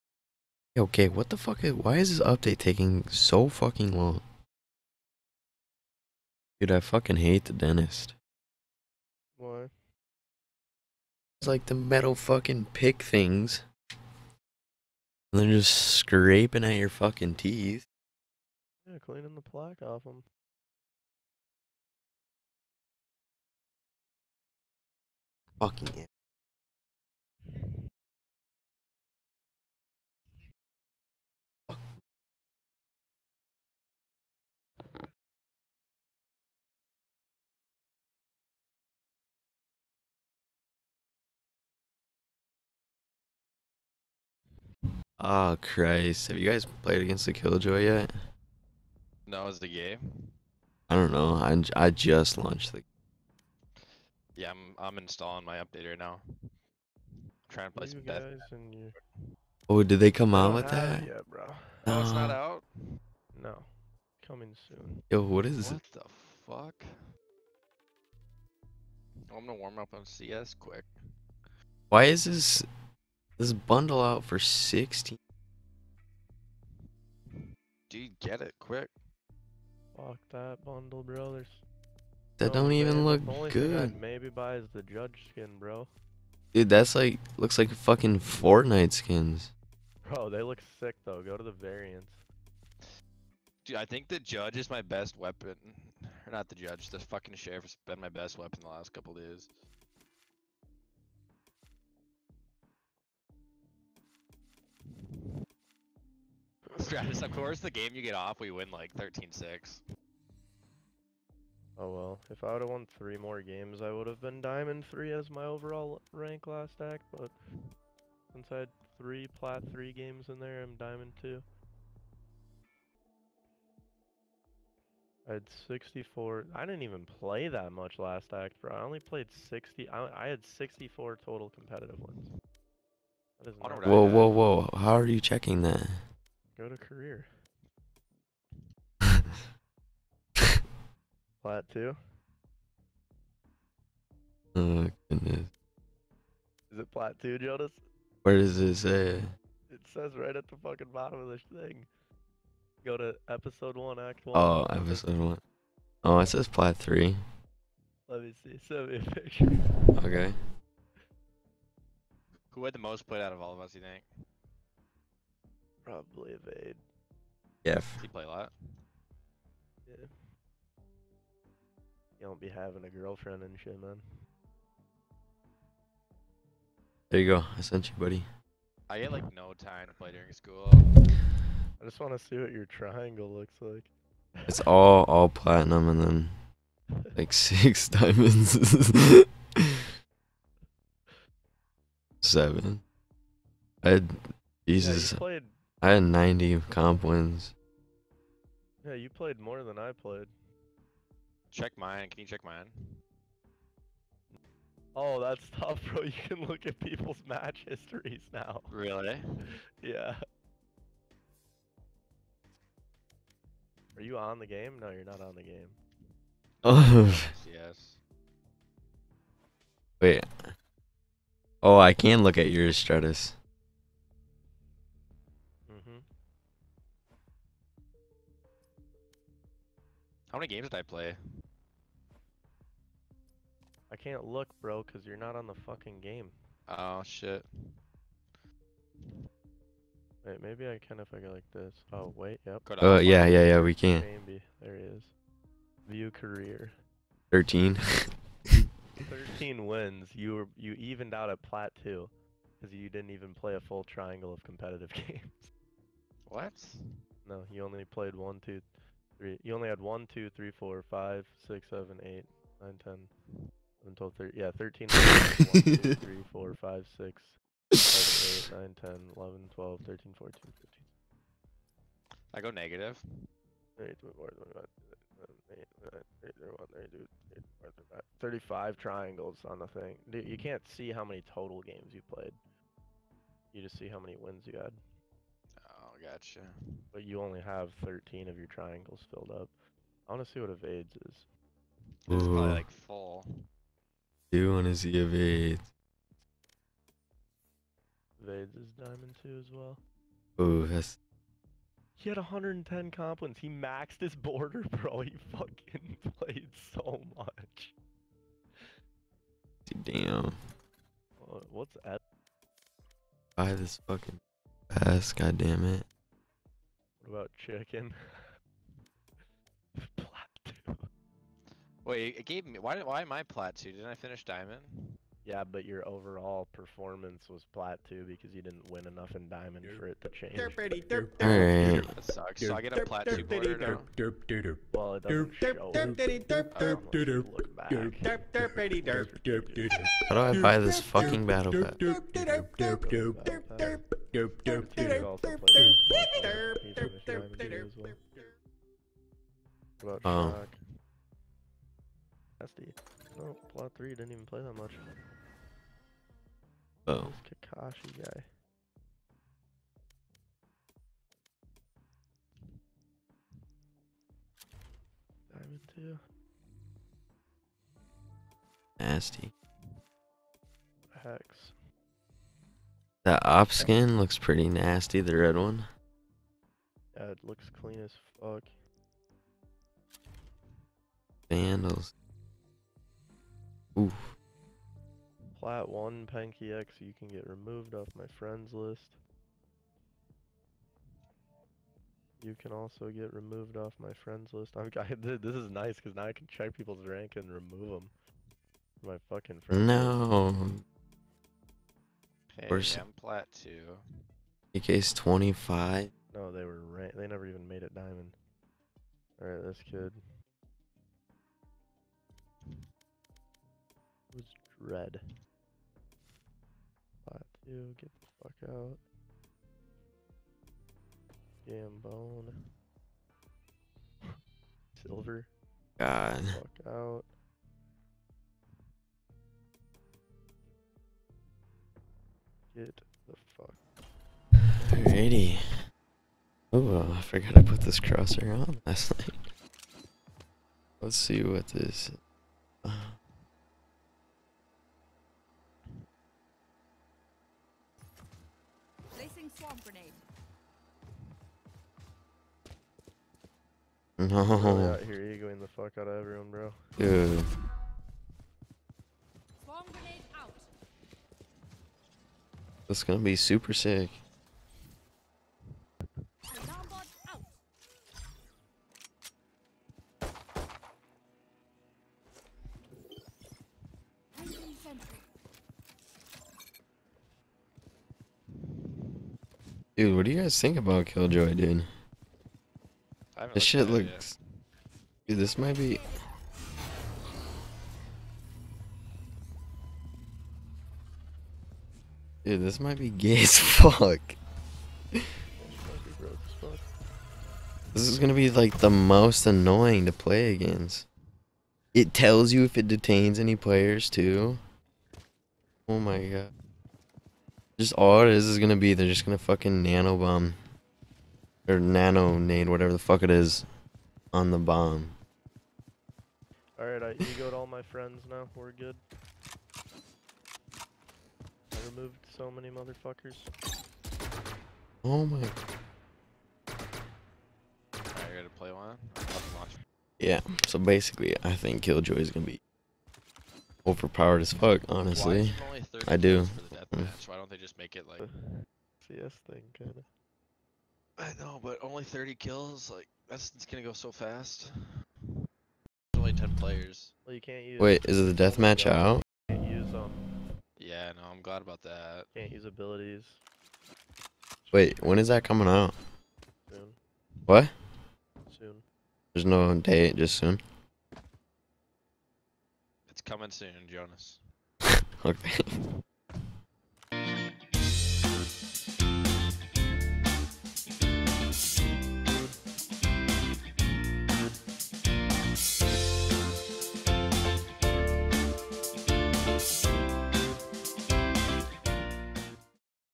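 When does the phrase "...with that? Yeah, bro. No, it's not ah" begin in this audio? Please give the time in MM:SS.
01:00.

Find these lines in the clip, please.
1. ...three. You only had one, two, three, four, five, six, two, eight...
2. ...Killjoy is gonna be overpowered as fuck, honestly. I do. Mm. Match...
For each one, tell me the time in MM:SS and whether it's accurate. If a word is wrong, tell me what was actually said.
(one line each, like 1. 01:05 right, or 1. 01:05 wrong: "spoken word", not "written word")
1. 04:19 wrong: "seven", not "two"
2. 08:51 right.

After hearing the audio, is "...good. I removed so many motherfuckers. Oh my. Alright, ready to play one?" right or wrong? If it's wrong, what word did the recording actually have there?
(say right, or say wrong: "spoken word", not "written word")
right.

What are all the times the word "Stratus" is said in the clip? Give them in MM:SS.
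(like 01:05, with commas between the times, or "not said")
01:46, 03:42.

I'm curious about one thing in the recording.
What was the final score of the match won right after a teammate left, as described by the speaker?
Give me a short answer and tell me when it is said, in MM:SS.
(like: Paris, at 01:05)
13-6, at 01:48.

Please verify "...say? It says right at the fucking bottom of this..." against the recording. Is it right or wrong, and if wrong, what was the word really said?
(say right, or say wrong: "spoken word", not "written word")
right.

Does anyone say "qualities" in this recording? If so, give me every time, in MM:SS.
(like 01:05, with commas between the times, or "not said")
not said.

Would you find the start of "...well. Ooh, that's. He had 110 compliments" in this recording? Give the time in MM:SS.
04:59.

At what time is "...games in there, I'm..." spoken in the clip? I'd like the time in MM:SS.
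01:59.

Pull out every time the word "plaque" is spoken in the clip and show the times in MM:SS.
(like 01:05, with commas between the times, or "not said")
00:19.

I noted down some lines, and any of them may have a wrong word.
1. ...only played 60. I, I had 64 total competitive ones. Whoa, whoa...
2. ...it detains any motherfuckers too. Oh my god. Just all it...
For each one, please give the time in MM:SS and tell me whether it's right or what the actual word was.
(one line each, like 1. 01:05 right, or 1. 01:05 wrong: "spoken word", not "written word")
1. 02:08 right
2. 08:22 wrong: "players", not "motherfuckers".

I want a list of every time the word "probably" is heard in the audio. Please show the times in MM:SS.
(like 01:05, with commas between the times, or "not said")
02:45, 04:52.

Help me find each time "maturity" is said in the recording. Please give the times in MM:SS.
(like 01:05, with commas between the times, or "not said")
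not said.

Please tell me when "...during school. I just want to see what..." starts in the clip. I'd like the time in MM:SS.
03:00.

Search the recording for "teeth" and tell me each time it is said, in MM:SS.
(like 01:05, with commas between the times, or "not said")
00:17.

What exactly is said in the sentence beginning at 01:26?
Dude, that's like looks like fucking Fortnite skins.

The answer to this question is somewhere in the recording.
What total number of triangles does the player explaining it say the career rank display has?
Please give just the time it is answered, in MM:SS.
04:38.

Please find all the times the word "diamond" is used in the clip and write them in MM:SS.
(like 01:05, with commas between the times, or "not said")
01:54, 02:00, 03:07, 04:58, 06:05, 06:47.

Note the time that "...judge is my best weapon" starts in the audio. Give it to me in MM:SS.
01:34.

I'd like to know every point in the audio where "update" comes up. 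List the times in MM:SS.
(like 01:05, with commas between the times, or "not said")
00:02, 00:55.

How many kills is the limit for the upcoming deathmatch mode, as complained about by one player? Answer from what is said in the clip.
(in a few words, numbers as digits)
30.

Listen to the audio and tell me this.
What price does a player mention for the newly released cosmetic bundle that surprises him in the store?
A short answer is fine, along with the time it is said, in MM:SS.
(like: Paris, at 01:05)
16, at 01:14.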